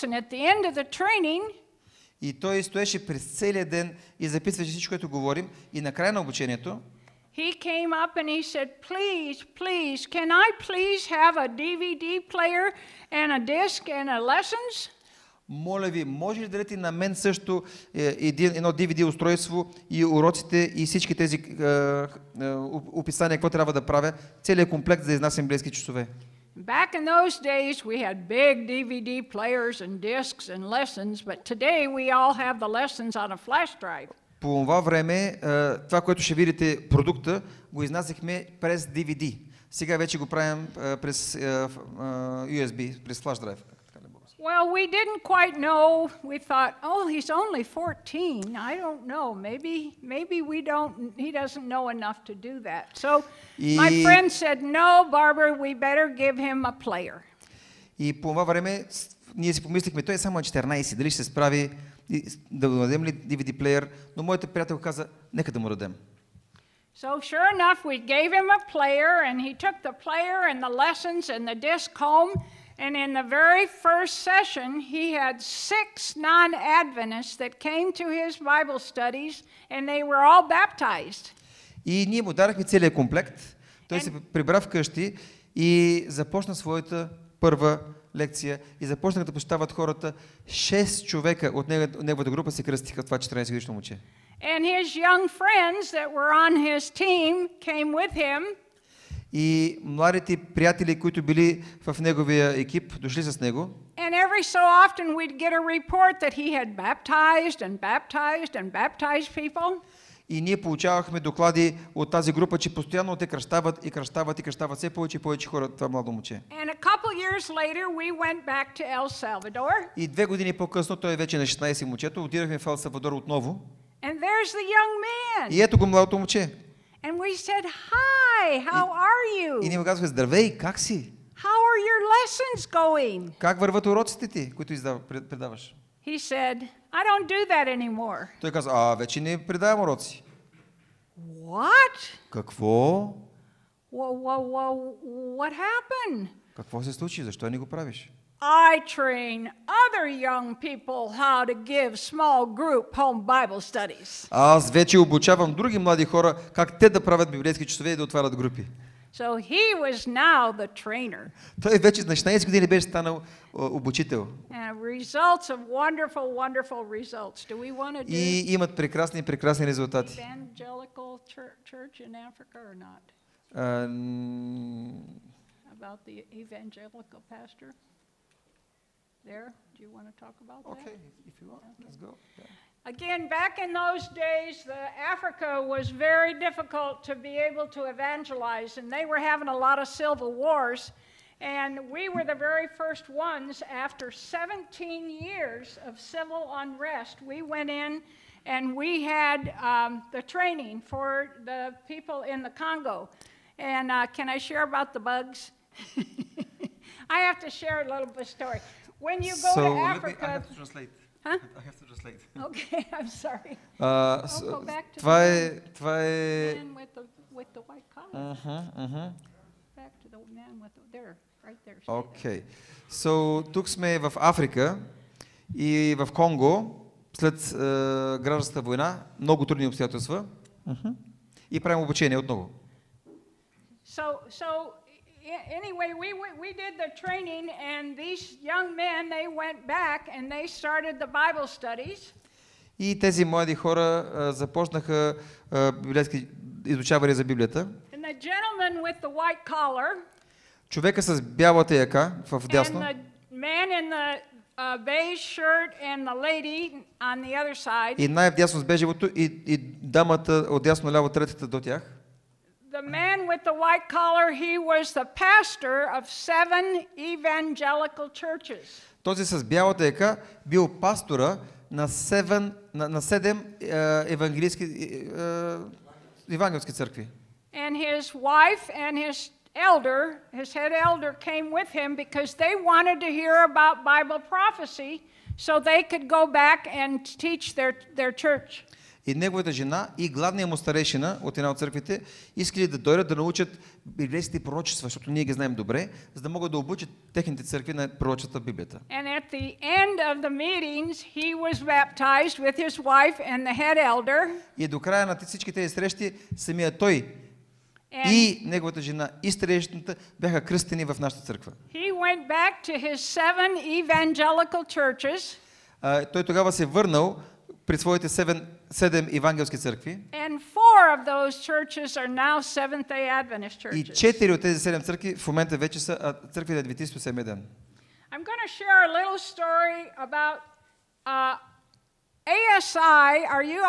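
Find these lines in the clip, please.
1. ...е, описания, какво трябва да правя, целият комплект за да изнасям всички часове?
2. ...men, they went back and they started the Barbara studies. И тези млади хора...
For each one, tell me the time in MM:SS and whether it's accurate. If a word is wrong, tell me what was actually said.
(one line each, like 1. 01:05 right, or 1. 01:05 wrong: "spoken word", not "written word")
1. 00:21 wrong: "библейски", not "всички"
2. 03:58 wrong: "Bible", not "Barbara".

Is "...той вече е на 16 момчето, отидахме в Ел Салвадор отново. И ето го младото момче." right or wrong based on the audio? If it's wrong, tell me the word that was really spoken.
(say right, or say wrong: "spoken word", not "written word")
right.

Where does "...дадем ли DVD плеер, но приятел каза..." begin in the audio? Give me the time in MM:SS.
01:02.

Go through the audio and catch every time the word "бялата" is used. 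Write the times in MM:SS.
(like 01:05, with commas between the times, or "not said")
04:11, 04:29.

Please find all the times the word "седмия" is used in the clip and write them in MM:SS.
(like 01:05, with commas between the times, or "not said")
05:27.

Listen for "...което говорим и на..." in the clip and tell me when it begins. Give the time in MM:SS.
00:04.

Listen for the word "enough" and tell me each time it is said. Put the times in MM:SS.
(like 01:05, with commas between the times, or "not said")
00:51, 01:07.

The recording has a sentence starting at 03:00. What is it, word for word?
Okay, if you want, let's go.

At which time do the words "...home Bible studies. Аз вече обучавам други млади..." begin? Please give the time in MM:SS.
02:32.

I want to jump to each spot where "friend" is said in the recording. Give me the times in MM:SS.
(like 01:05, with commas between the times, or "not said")
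00:54, 01:35.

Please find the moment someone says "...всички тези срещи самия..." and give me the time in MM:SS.
05:05.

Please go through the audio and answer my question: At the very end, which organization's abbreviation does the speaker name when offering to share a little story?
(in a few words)
ASI.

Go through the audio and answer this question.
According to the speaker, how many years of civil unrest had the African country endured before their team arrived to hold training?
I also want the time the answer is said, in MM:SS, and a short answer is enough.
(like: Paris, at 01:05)
17, at 03:14.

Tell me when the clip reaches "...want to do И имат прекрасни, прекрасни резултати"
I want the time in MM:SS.
02:47.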